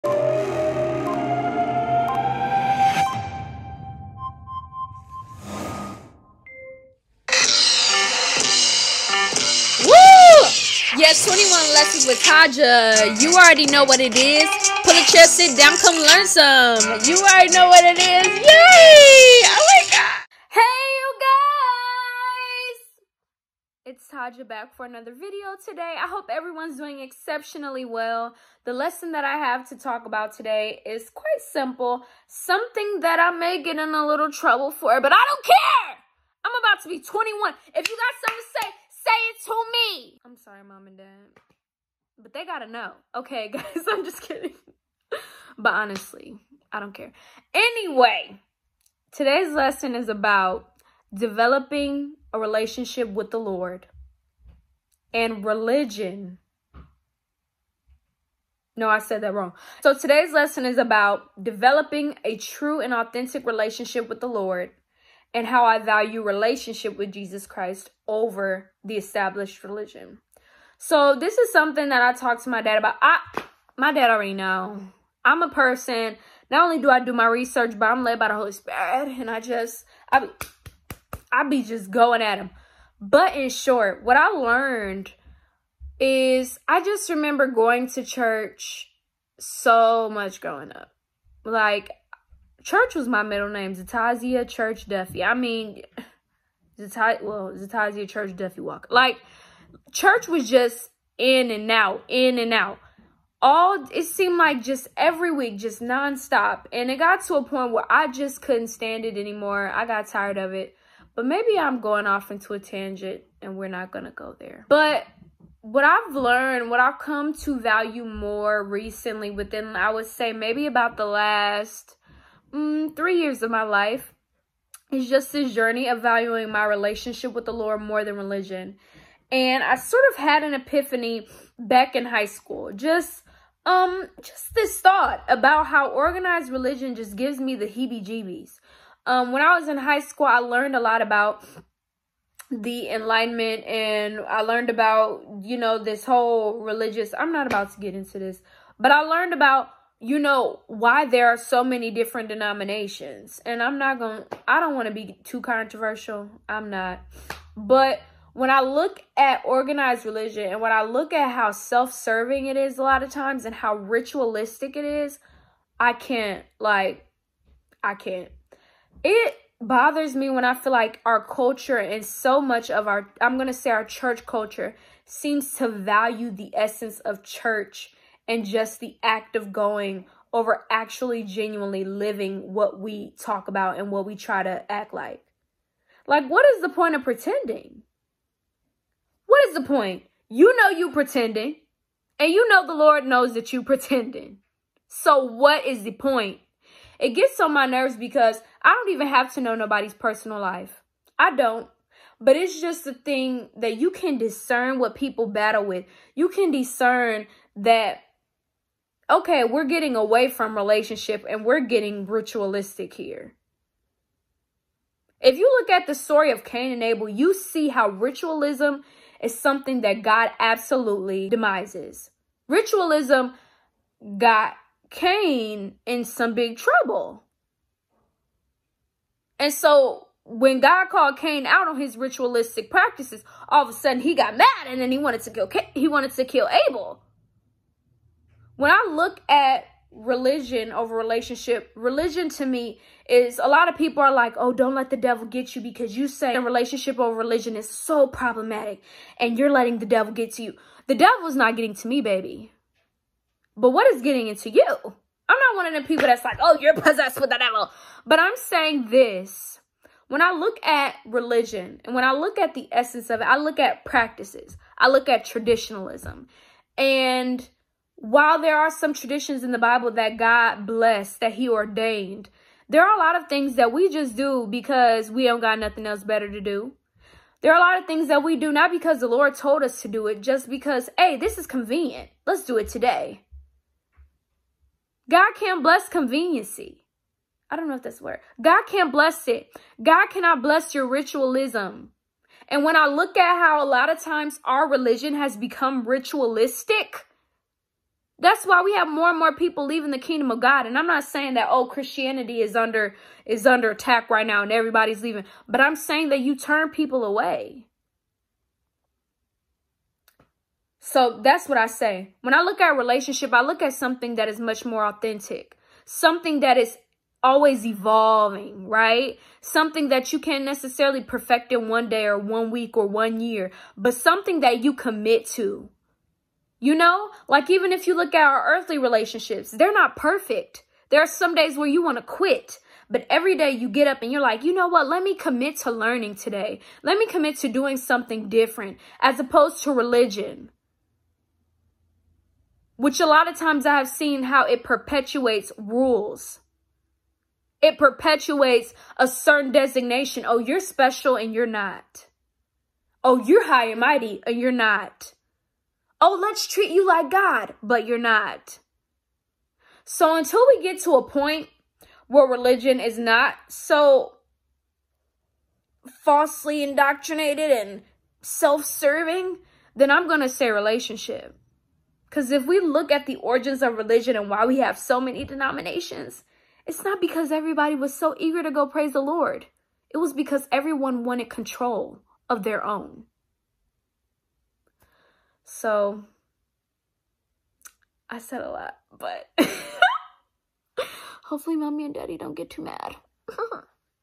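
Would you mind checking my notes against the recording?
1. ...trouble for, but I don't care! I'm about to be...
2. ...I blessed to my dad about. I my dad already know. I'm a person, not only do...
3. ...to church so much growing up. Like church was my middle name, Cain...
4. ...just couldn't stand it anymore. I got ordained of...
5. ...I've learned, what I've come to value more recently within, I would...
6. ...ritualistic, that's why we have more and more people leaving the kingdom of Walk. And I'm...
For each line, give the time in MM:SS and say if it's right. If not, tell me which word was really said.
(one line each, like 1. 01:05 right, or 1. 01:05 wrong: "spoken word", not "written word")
1. 00:34 right
2. 01:12 wrong: "talked", not "blessed"
3. 01:27 wrong: "Zatozia", not "Cain"
4. 01:48 wrong: "tired", not "ordained"
5. 01:55 right
6. 04:55 wrong: "God", not "Walk".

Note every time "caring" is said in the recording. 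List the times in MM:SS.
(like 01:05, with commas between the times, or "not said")
not said.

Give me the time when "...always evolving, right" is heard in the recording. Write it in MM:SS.
05:17.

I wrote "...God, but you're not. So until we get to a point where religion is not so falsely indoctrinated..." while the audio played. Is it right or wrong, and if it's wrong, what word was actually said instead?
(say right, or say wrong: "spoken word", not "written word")
right.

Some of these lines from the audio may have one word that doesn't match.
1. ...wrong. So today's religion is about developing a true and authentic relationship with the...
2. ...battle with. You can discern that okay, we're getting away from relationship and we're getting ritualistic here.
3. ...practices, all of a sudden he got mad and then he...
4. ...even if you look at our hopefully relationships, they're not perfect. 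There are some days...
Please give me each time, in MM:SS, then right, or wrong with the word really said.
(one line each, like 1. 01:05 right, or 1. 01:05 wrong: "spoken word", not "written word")
1. 00:59 wrong: "lesson", not "religion"
2. 03:25 right
3. 03:52 right
4. 05:27 wrong: "earthly", not "hopefully".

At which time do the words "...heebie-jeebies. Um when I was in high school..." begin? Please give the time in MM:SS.
02:17.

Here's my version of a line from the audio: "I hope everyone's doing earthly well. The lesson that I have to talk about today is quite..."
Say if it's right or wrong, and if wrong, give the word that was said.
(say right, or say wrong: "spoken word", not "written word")
wrong: "exceptionally", not "earthly".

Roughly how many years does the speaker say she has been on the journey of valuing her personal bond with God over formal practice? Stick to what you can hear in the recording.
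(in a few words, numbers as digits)
3.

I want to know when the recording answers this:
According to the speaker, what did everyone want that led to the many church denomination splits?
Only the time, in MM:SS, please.
06:21.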